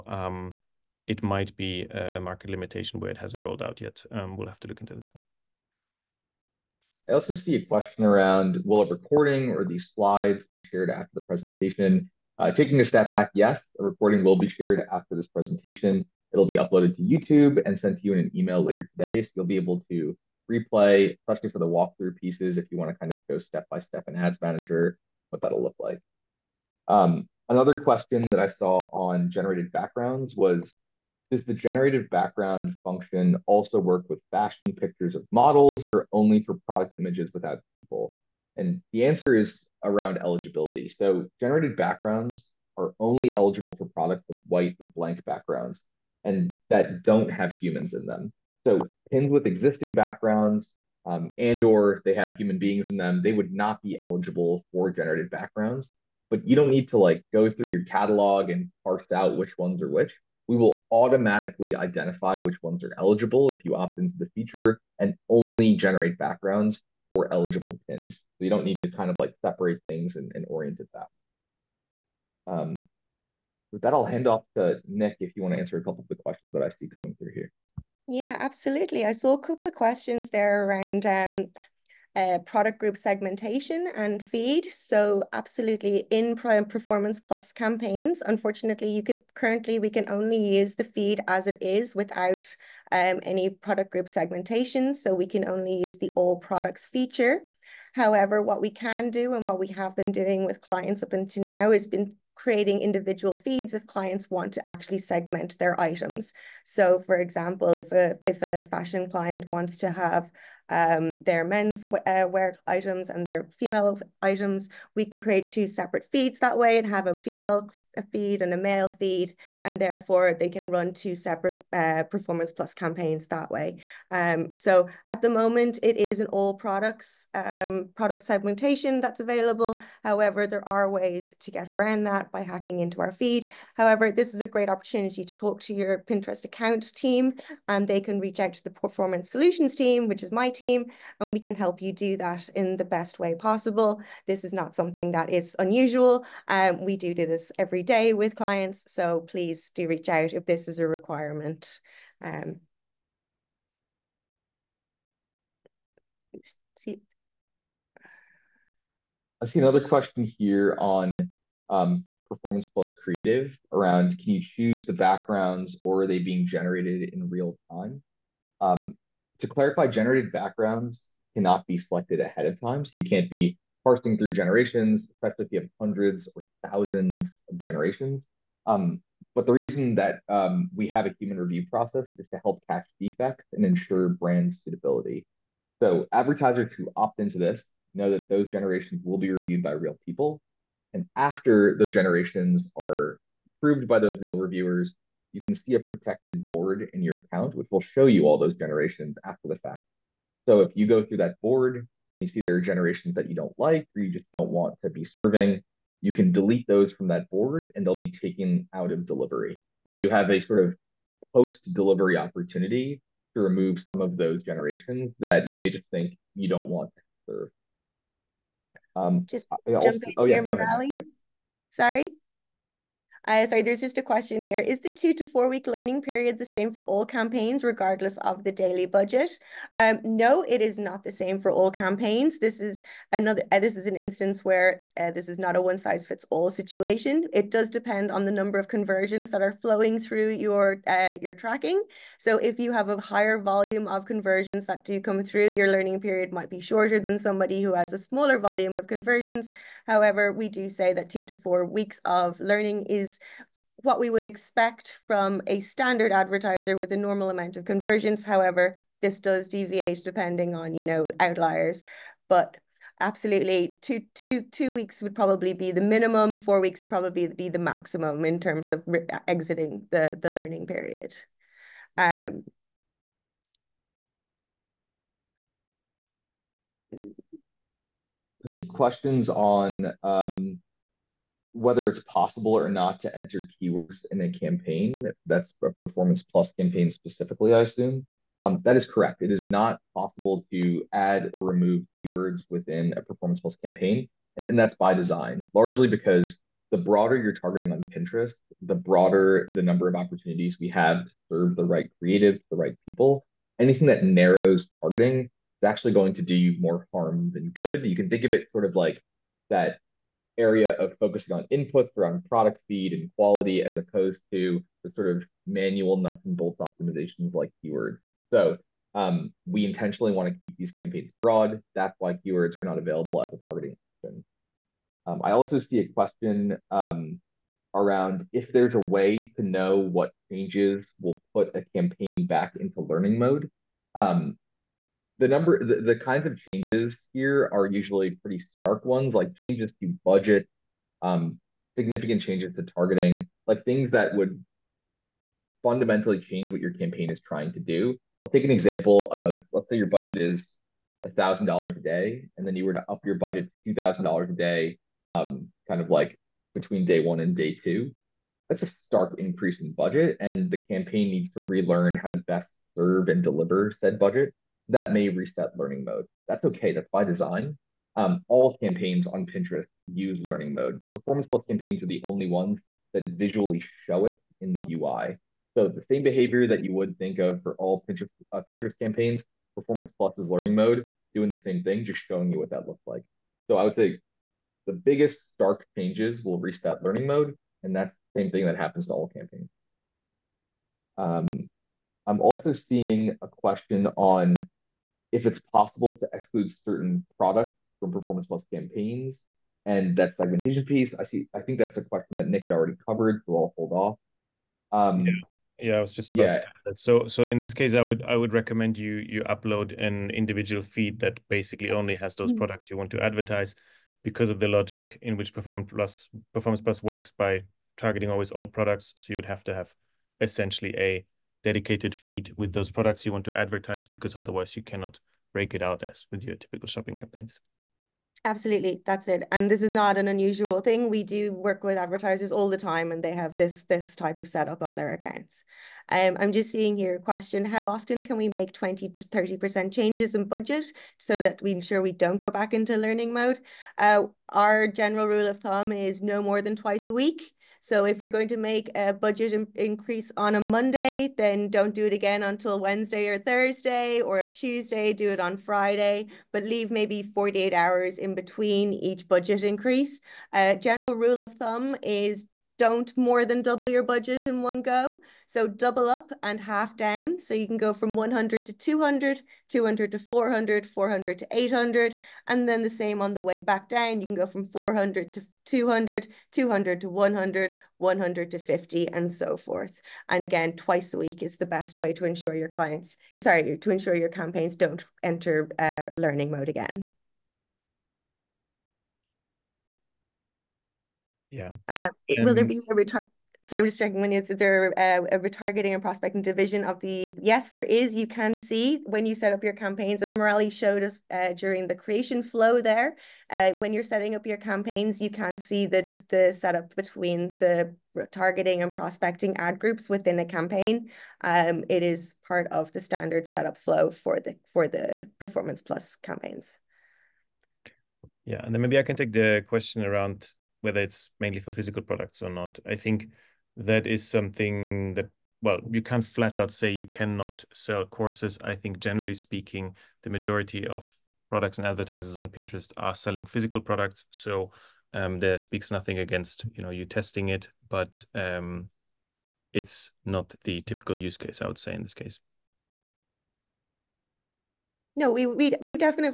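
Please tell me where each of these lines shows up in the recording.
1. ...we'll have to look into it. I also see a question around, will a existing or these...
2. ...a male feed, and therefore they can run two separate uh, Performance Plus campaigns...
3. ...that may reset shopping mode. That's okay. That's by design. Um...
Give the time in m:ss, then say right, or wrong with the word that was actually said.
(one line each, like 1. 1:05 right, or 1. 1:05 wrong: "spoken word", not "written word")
1. 0:04 wrong: "recording", not "existing"
2. 1:58 right
3. 6:04 wrong: "learning", not "shopping".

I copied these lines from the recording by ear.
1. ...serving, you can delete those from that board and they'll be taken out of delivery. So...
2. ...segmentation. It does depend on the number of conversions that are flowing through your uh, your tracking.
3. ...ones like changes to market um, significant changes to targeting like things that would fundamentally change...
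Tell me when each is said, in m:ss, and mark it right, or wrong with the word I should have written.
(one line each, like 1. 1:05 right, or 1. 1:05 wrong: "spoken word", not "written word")
1. 3:25 right
2. 3:56 wrong: "situation", not "segmentation"
3. 5:38 wrong: "budget", not "market".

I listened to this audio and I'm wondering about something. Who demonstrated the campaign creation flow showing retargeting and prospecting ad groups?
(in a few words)
Murali.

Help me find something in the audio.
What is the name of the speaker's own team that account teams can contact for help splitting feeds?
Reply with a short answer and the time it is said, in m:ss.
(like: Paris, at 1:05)
Performance Solutions team, at 2:18.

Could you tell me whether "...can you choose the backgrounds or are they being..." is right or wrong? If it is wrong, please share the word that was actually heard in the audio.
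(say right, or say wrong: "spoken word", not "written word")
right.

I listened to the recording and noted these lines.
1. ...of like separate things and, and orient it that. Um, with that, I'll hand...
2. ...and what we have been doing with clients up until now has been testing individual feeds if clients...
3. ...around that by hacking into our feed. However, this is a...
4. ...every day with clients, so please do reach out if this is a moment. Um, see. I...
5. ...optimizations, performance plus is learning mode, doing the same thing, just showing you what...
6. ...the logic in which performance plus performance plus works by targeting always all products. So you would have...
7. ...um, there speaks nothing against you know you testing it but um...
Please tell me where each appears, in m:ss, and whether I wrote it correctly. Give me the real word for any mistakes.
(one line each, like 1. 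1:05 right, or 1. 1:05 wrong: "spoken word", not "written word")
1. 1:09 right
2. 1:39 wrong: "creating", not "testing"
3. 2:11 right
4. 2:27 wrong: "requirement", not "moment"
5. 6:18 wrong: "campaigns", not "optimizations"
6. 6:54 right
7. 8:54 right.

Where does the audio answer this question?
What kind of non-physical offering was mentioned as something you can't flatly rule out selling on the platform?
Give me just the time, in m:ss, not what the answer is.
8:47.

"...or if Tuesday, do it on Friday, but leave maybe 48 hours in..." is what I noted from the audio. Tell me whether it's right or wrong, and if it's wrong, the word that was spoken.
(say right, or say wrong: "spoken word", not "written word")
right.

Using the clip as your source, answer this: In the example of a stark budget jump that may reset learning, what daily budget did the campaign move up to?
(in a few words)
$2000.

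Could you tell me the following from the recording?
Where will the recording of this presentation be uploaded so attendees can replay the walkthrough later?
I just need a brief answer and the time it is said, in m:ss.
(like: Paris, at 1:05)
YouTube, at 0:17.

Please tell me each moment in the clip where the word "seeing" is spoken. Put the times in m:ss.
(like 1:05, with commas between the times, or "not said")
6:32, 7:16.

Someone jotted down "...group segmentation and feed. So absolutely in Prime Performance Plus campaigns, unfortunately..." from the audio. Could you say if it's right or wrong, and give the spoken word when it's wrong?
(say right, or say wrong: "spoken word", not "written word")
right.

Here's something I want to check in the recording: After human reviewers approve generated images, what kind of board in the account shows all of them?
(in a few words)
protected board.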